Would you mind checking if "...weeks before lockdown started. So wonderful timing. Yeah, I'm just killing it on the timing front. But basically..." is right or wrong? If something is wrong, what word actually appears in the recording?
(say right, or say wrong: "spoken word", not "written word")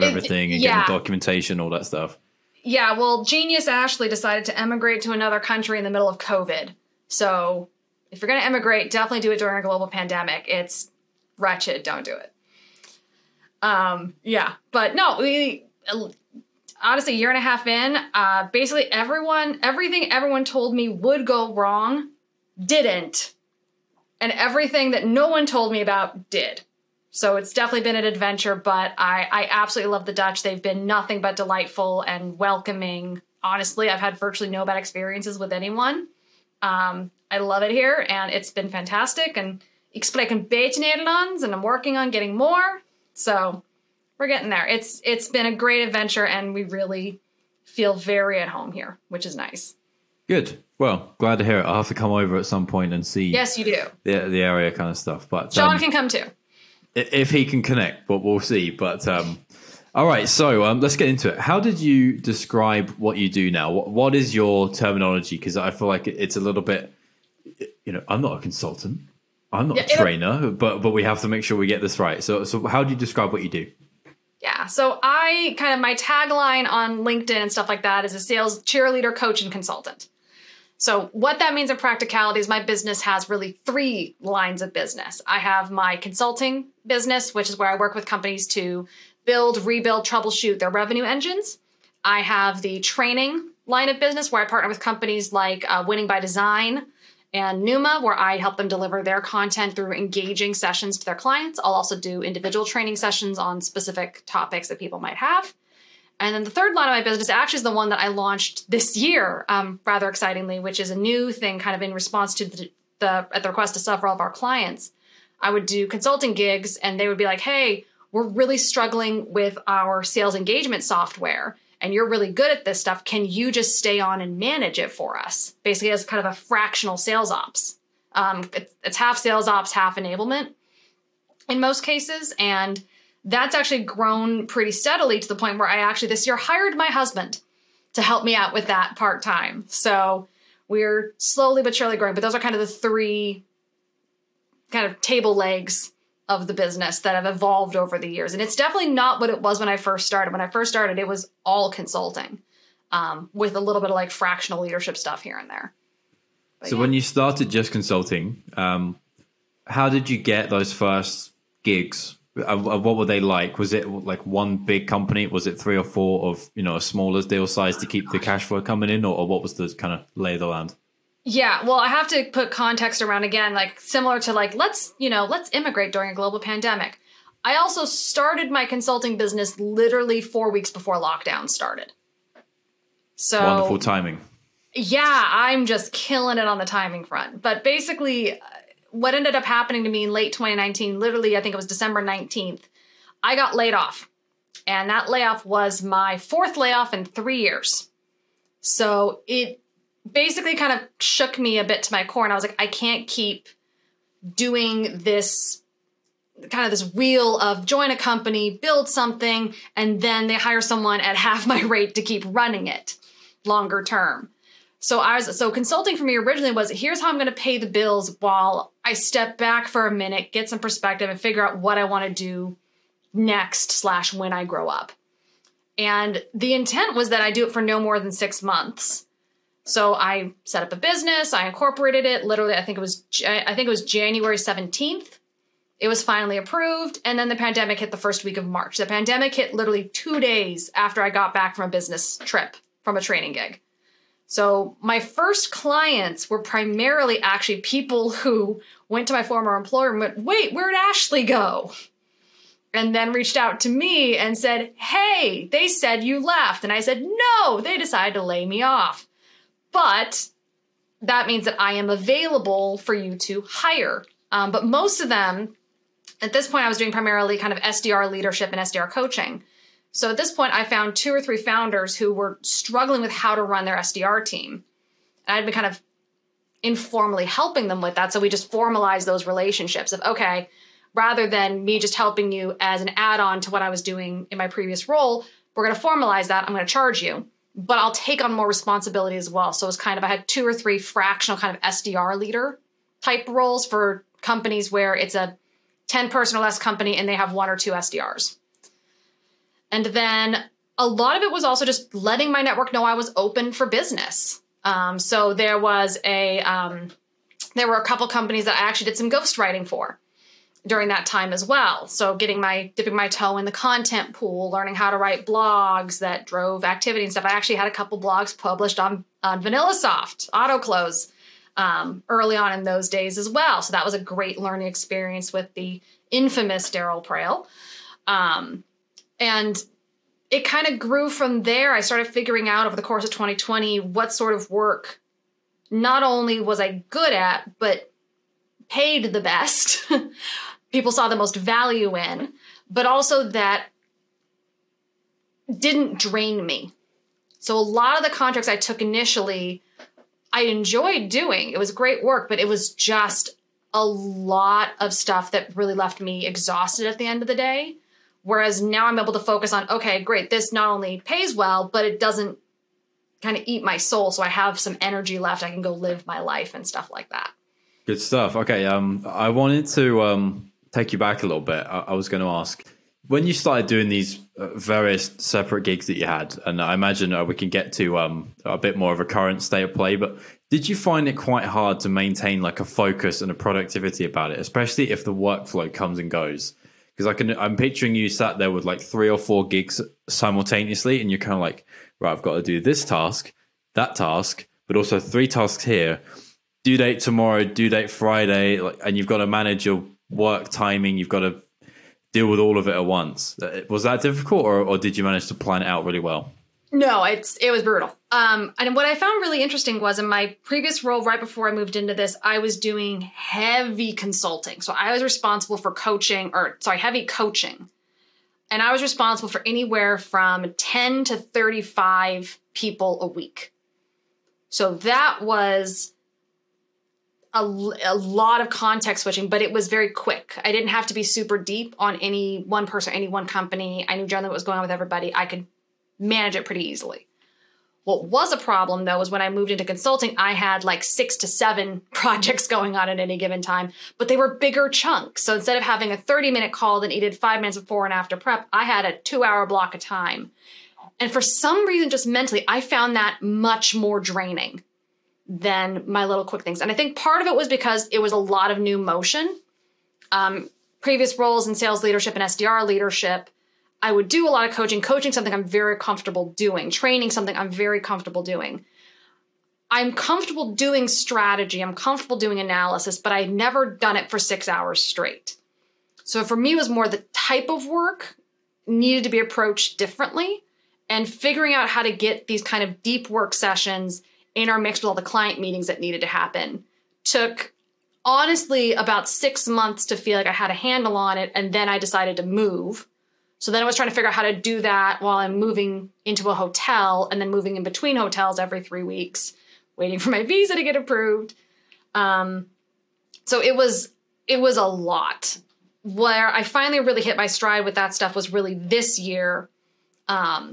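right.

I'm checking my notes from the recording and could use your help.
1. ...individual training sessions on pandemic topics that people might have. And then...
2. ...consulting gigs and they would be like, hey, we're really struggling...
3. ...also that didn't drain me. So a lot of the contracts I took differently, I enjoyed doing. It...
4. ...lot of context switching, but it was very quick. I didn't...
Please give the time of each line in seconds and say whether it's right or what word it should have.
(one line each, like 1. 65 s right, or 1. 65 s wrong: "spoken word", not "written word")
1. 102 s wrong: "specific", not "pandemic"
2. 115 s right
3. 342 s wrong: "initially", not "differently"
4. 427 s right.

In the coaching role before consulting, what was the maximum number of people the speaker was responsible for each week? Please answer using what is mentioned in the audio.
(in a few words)
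35.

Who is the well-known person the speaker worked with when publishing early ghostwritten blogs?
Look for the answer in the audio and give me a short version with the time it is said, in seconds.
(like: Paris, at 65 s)
Darryl Praill, at 326 s.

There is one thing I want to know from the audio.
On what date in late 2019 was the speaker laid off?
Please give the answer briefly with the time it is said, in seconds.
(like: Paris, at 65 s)
December 19th, at 191 s.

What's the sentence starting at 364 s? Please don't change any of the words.
So I have some energy left.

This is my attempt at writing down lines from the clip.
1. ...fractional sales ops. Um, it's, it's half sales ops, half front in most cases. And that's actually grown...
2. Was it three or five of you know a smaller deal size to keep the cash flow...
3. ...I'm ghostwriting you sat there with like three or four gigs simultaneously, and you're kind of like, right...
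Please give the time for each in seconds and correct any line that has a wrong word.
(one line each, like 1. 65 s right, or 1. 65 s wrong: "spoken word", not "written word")
1. 126 s wrong: "enablement", not "front"
2. 165 s wrong: "four", not "five"
3. 387 s wrong: "picturing", not "ghostwriting".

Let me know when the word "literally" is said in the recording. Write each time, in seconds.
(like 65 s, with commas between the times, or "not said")
179 s, 190 s, 232 s, 239 s.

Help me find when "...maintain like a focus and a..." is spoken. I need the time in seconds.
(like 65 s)
381 s.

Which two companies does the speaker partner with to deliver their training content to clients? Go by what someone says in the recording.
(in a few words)
Winning by Design and Numa.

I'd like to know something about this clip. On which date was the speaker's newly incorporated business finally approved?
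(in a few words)
January 17th.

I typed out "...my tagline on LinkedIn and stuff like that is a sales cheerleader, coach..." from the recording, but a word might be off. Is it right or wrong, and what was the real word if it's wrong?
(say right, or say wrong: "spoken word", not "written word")
right.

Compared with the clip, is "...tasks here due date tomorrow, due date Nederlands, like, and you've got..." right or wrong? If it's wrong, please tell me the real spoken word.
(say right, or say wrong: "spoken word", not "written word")
wrong: "Friday", not "Nederlands".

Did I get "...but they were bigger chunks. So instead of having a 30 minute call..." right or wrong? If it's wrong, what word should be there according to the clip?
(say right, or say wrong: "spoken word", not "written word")
right.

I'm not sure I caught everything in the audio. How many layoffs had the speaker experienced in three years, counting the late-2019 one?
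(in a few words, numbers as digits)
4.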